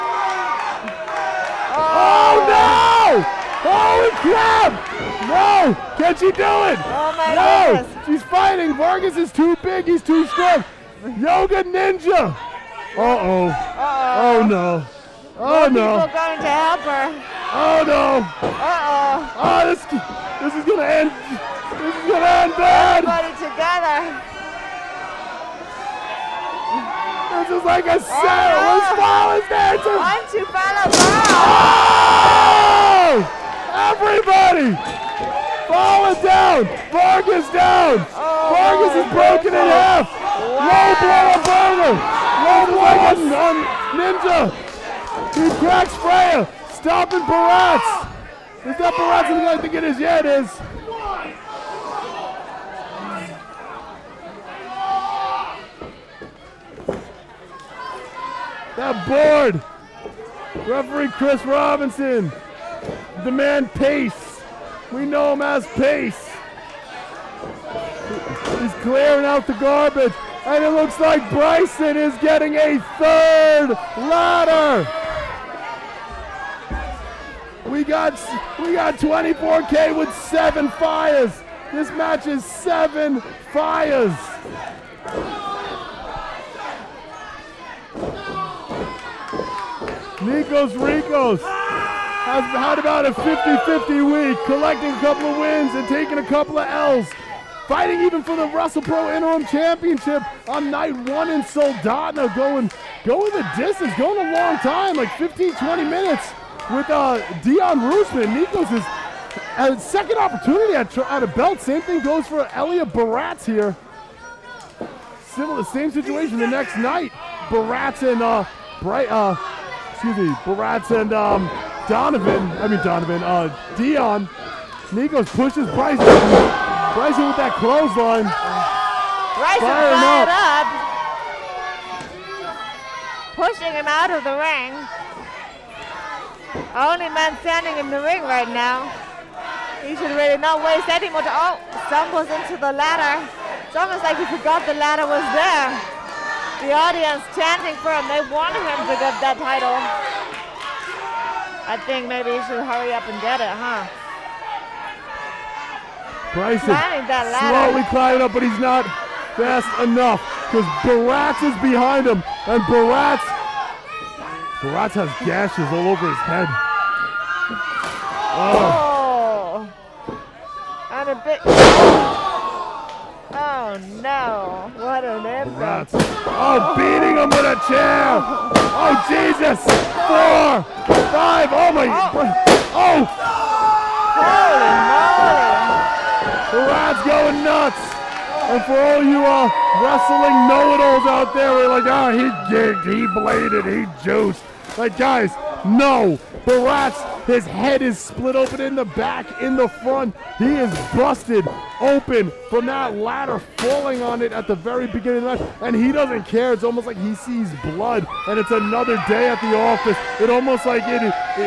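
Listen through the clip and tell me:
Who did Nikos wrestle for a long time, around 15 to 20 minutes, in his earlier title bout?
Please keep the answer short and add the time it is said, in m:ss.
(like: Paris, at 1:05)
Dion Roosman, at 1:47.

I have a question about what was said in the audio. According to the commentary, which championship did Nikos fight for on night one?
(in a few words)
WrestlePro Interim Championship.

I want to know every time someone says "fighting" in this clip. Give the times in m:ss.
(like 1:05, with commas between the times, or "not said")
0:08, 1:37.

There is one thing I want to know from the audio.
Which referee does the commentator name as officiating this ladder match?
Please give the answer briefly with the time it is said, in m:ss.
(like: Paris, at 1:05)
Chris Robinson, at 1:01.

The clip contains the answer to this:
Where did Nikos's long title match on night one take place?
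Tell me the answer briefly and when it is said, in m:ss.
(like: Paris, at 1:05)
Soldotna, at 1:41.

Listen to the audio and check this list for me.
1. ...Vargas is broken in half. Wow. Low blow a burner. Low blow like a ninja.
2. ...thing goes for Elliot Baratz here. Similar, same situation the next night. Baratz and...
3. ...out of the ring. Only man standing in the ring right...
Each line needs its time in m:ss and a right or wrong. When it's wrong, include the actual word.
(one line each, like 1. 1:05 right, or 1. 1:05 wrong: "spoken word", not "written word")
1. 0:38 right
2. 1:51 right
3. 2:13 right.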